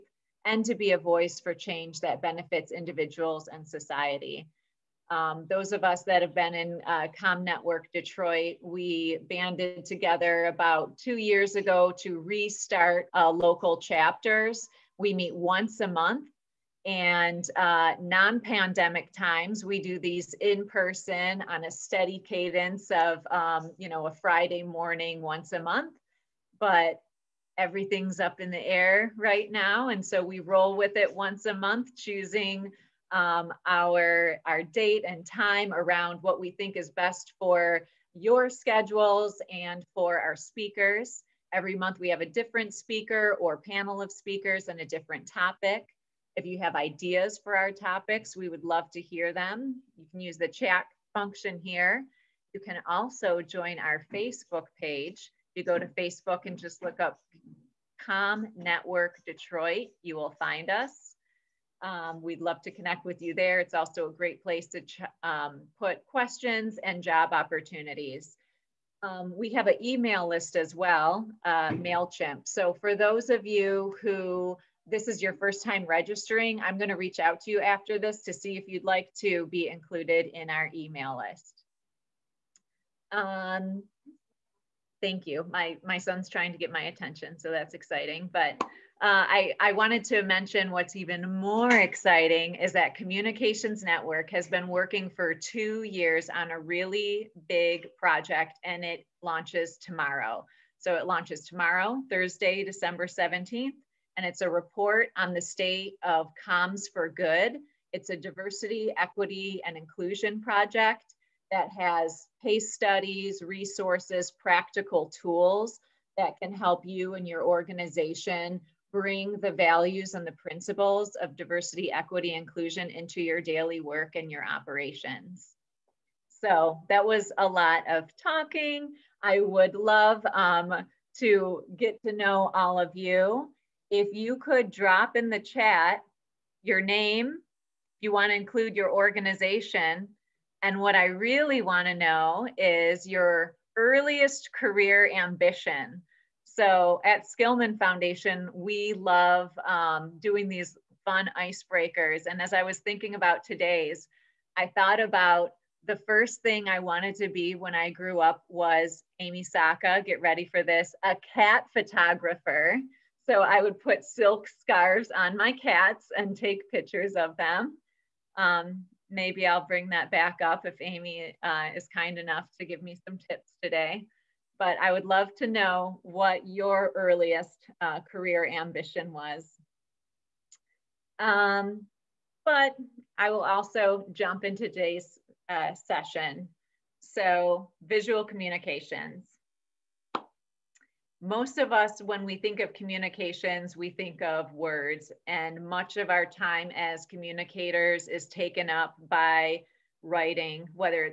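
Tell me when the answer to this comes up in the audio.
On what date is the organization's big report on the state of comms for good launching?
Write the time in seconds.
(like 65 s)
102 s.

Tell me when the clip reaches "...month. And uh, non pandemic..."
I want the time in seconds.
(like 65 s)
15 s.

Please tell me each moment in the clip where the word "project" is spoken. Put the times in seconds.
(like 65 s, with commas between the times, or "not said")
97 s, 110 s.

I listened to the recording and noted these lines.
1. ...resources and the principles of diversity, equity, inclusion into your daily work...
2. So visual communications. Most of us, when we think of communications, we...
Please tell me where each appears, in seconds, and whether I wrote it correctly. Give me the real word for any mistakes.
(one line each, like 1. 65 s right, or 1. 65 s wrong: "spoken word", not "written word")
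1. 119 s wrong: "values", not "resources"
2. 187 s right.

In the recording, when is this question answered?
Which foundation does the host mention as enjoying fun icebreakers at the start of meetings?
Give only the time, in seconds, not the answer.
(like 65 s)
147 s.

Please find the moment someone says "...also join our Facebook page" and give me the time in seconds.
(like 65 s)
52 s.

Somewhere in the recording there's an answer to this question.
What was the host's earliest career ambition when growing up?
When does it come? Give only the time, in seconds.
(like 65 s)
161 s.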